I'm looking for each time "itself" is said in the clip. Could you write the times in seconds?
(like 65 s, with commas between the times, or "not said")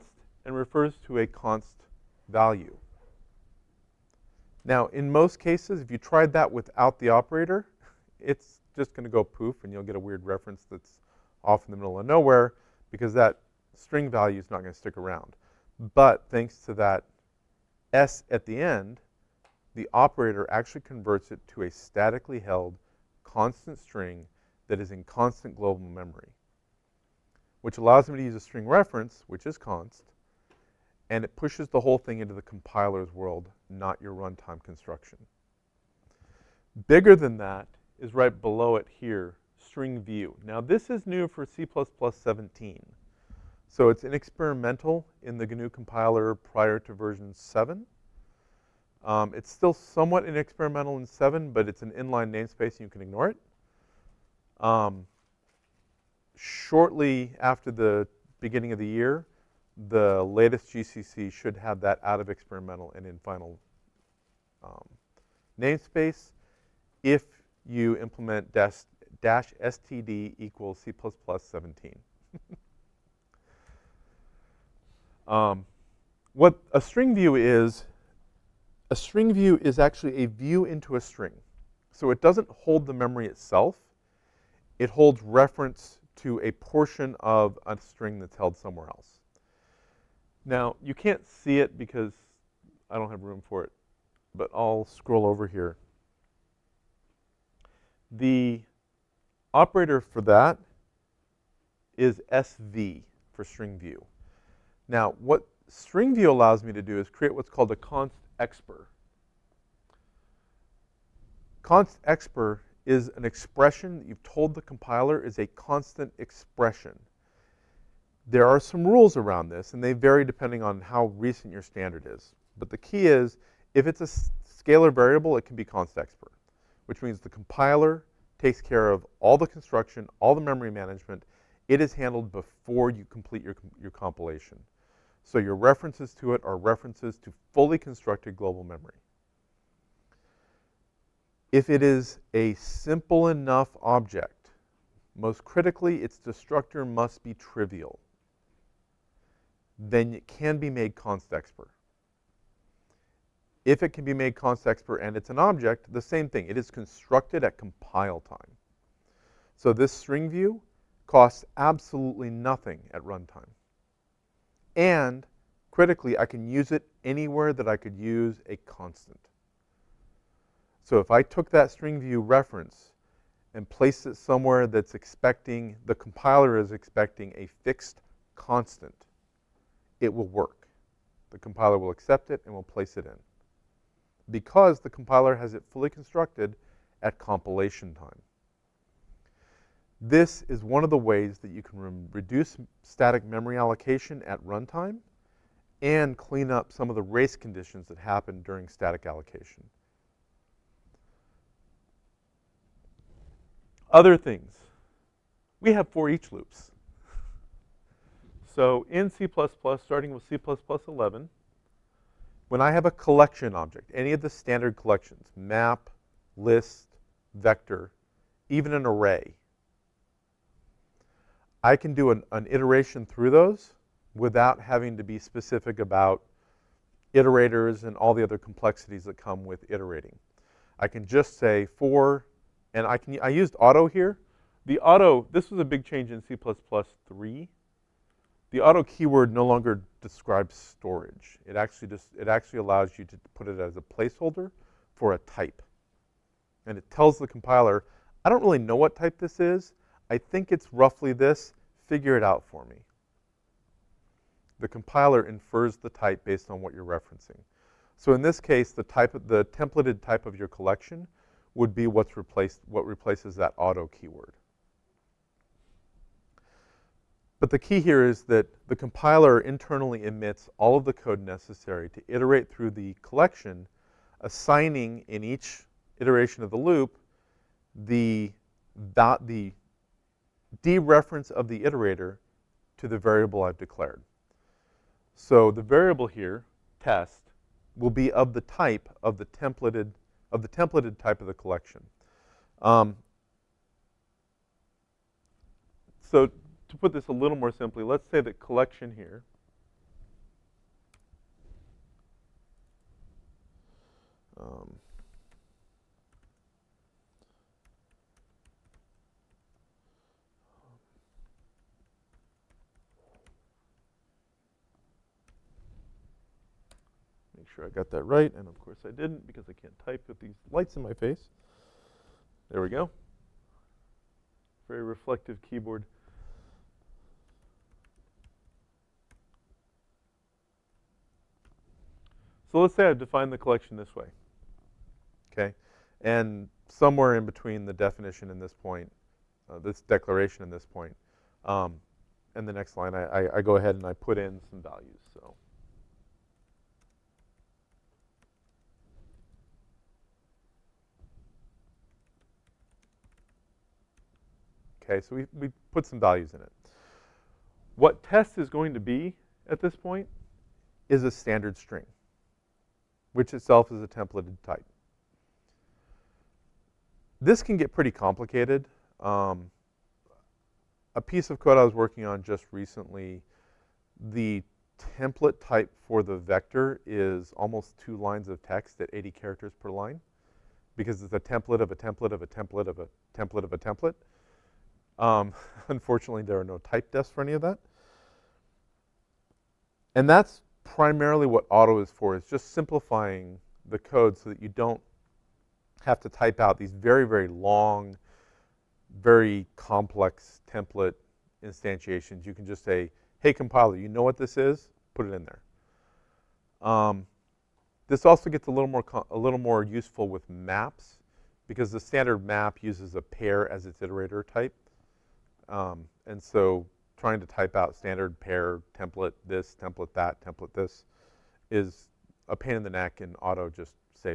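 83 s, 363 s.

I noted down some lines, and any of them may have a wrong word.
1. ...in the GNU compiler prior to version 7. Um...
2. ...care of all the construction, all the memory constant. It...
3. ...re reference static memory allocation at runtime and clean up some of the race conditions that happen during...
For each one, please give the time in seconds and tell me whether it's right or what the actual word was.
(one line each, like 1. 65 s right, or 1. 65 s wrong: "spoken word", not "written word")
1. 45 s right
2. 128 s wrong: "management", not "constant"
3. 191 s wrong: "reduce", not "reference".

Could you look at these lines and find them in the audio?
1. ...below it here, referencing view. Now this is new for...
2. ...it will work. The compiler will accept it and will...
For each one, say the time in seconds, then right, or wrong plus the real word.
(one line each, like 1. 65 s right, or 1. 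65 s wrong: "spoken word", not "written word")
1. 38 s wrong: "string", not "referencing"
2. 180 s right.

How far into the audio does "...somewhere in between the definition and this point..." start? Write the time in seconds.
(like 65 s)
336 s.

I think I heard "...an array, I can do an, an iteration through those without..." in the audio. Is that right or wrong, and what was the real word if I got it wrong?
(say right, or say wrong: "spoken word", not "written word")
right.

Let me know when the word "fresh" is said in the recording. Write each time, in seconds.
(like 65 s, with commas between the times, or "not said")
not said.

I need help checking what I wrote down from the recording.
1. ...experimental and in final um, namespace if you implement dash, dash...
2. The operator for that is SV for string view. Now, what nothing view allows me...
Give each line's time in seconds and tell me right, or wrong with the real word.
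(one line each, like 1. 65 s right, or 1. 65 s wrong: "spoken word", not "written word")
1. 62 s right
2. 98 s wrong: "string", not "nothing".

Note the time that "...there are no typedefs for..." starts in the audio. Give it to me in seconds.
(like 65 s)
386 s.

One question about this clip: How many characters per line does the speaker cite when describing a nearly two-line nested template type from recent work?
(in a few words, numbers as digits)
80.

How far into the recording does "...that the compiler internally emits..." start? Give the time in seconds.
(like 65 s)
268 s.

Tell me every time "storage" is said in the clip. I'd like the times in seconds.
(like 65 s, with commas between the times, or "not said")
240 s.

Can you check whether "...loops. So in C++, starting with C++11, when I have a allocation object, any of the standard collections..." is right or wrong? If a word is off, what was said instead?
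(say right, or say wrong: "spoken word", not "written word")
wrong: "collection", not "allocation".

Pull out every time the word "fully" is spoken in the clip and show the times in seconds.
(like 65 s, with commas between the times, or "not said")
137 s, 185 s.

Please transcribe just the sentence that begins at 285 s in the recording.
So the variable here, test, will be of the type of the templated, of the templated type of the collection.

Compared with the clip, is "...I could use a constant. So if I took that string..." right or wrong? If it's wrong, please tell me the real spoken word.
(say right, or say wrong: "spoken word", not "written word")
right.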